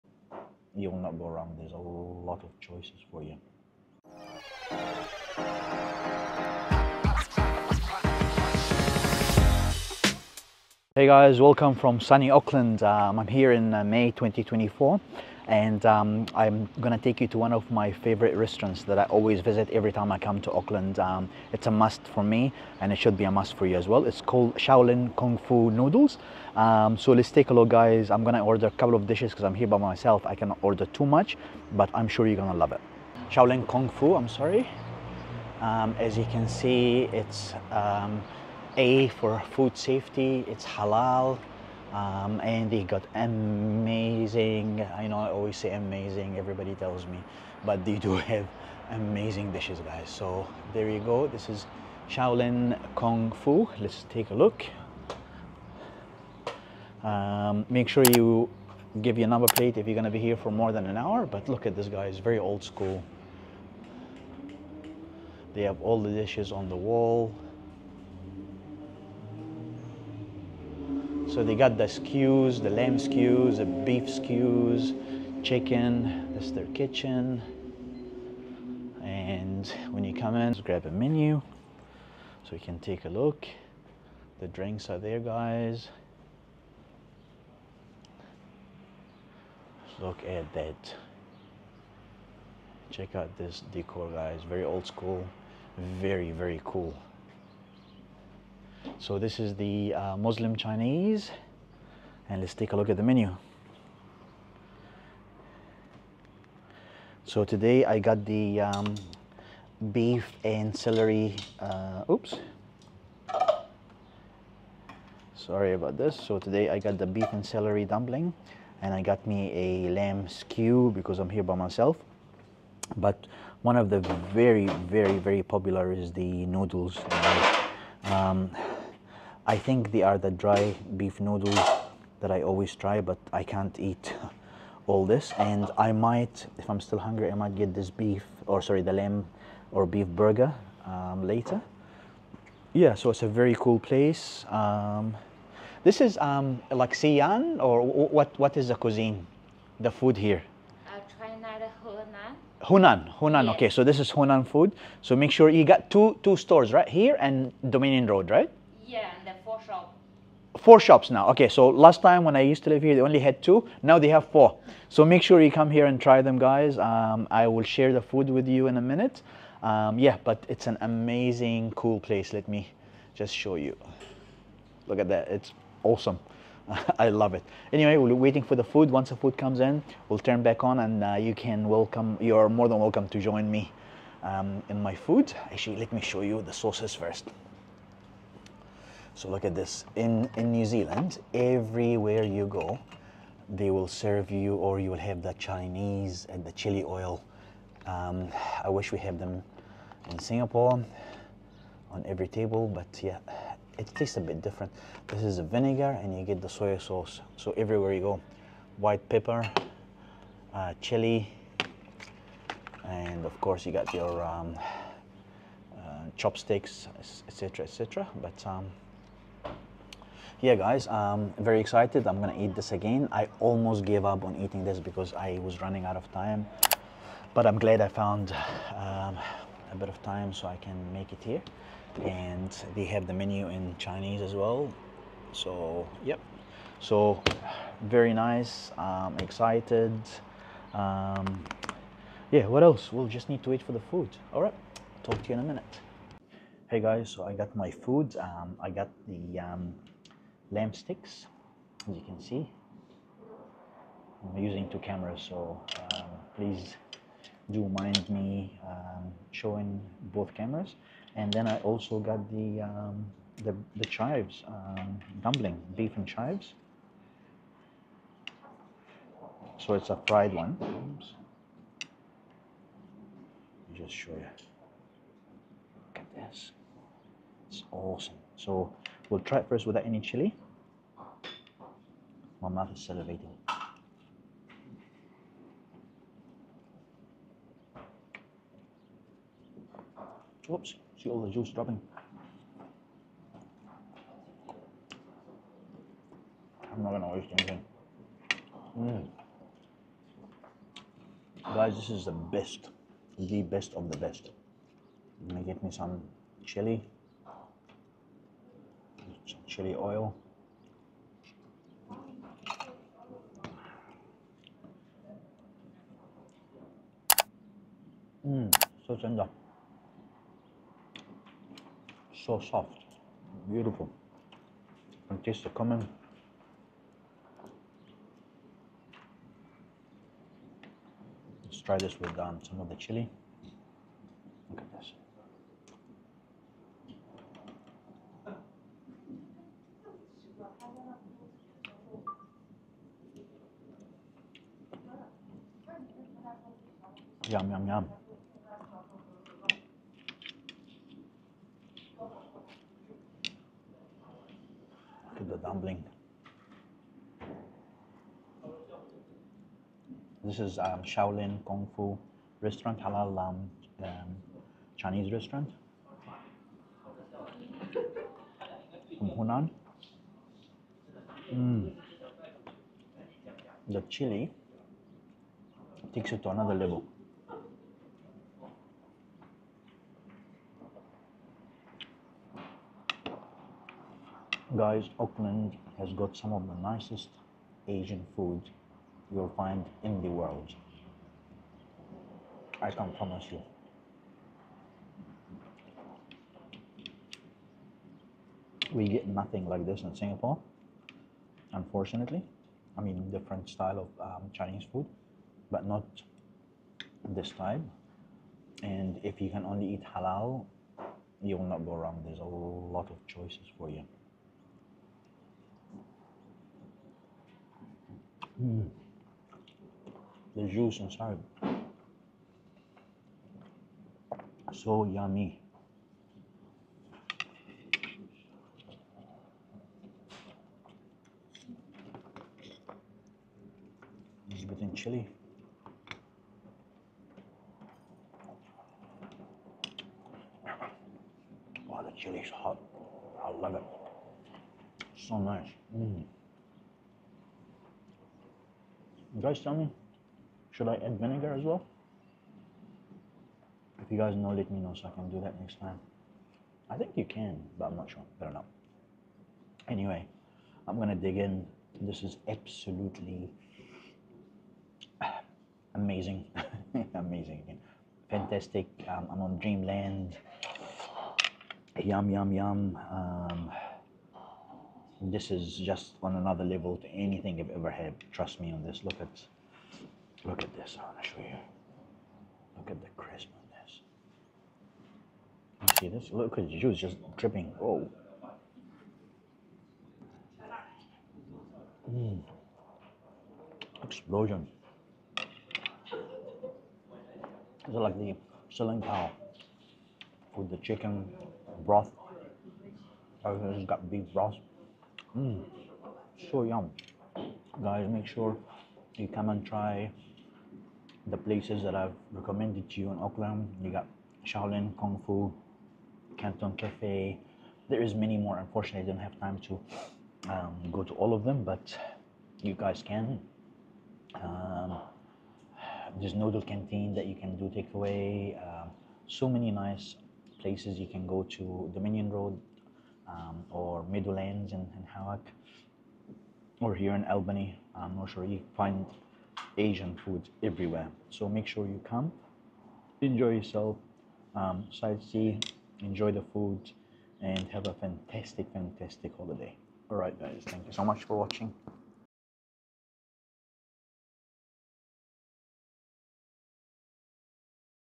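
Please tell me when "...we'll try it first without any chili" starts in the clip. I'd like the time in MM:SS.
04:39.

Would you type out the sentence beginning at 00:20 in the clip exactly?
Um, it's a must for me and it should be a must for you as well.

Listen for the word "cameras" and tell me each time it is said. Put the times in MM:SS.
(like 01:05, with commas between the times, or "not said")
04:14, 04:20.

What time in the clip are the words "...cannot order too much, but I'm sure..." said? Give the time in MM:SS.
00:30.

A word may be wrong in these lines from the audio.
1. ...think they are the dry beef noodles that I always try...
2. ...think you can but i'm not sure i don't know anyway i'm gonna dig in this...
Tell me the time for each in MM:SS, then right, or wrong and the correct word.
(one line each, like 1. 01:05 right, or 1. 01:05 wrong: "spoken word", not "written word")
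1. 02:09 right
2. 07:36 right.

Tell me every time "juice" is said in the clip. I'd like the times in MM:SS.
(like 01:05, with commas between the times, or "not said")
04:51, 07:00, 08:06.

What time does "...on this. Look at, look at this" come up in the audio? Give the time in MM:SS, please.
07:58.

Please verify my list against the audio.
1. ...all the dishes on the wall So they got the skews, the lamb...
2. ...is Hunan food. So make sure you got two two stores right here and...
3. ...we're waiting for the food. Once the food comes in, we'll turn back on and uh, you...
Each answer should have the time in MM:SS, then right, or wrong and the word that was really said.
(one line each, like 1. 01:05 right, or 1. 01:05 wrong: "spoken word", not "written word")
1. 01:05 right
2. 02:33 right
3. 02:57 right.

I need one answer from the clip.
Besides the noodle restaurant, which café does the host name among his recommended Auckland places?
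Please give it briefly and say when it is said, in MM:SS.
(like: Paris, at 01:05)
Canton Cafe, at 08:36.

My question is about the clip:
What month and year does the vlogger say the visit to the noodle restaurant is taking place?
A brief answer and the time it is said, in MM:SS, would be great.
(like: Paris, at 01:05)
May 2024, at 00:13.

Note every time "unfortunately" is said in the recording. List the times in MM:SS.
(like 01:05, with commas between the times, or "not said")
06:41, 08:38.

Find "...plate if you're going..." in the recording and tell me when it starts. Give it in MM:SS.
00:59.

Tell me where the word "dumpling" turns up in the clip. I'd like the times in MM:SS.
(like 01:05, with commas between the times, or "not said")
01:57, 04:25.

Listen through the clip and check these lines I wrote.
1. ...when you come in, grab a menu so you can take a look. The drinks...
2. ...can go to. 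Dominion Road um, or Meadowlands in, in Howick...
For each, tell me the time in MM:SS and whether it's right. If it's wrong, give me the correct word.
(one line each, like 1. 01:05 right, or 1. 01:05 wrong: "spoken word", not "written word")
1. 01:19 right
2. 08:50 right.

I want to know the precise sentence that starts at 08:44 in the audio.
Um, there's noodle canteen that you can do takeaway.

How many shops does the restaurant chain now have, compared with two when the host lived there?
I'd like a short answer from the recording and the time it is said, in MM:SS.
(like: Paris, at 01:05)
4, at 02:40.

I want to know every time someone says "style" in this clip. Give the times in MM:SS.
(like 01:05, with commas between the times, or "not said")
06:43.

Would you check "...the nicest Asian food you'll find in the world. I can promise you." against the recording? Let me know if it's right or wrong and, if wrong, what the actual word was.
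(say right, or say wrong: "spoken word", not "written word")
right.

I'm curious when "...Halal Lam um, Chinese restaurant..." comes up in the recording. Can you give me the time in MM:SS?
06:02.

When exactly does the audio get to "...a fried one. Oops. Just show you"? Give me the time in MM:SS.
04:29.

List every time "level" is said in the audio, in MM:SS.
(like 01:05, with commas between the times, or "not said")
06:16, 07:56.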